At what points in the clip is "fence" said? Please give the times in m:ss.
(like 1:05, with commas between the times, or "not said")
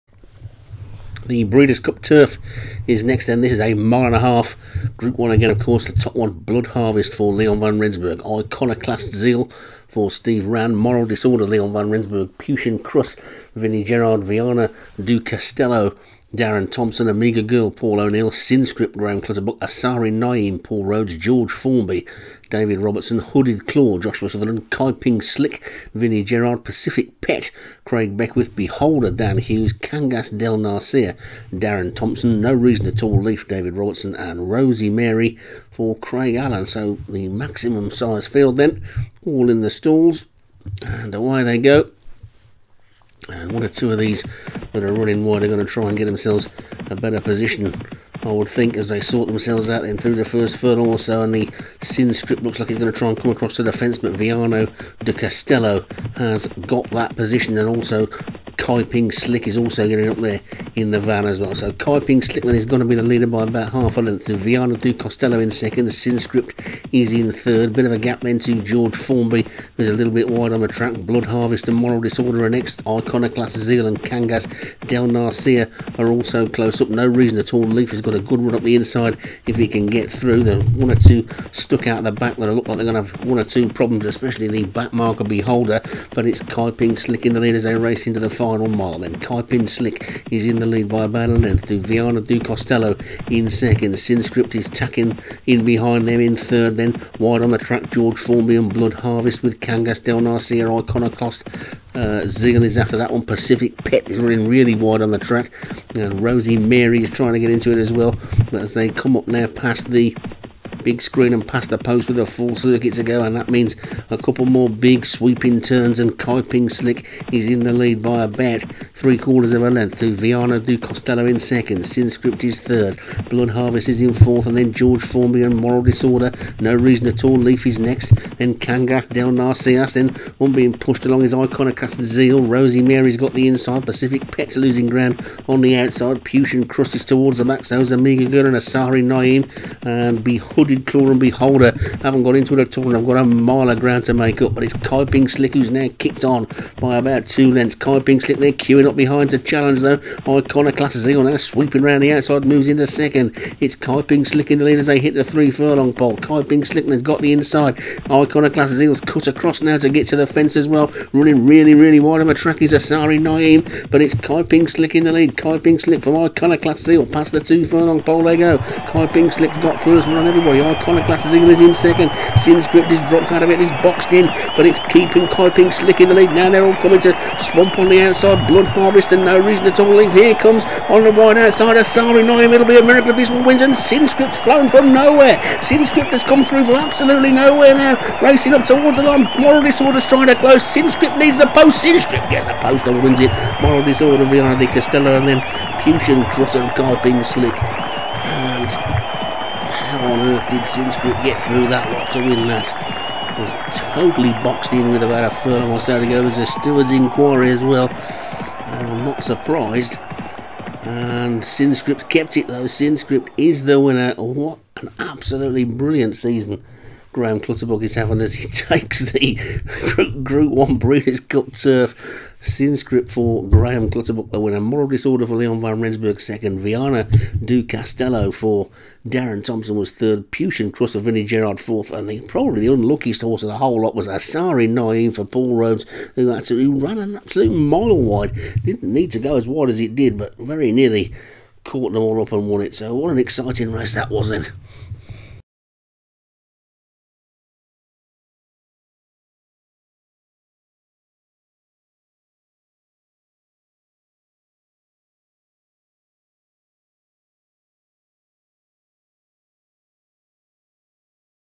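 0:53, 2:40.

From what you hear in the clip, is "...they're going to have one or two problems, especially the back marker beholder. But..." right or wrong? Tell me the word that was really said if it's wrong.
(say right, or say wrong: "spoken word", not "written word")
right.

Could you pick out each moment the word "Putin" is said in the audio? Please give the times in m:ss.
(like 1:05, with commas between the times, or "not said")
2:16, 3:15, 3:50.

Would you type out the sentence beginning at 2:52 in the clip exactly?
Sinscript is dropped out of it He's boxed in, but it's keeping Kaiping slick in the lead.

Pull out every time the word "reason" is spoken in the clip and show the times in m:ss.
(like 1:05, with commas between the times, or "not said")
0:32, 1:17, 2:06, 2:59.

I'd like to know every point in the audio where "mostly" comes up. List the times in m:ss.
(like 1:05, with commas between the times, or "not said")
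not said.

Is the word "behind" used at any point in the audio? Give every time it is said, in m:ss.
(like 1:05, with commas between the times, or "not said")
1:35, 2:28.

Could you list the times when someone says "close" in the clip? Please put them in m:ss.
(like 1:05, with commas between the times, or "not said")
1:16, 3:10.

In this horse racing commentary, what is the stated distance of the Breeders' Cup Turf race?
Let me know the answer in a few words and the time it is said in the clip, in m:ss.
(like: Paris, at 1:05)
a mile and a half, at 0:03.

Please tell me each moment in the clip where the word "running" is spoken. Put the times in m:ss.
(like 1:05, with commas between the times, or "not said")
0:44, 1:44, 2:41.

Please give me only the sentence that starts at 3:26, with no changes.
There's a steward's inquiry as well.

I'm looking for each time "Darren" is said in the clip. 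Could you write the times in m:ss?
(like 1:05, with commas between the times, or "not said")
0:16, 0:31, 3:49.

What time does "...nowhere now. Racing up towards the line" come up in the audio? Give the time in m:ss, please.
3:07.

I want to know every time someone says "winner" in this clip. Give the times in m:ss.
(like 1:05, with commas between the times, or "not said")
3:33, 3:44.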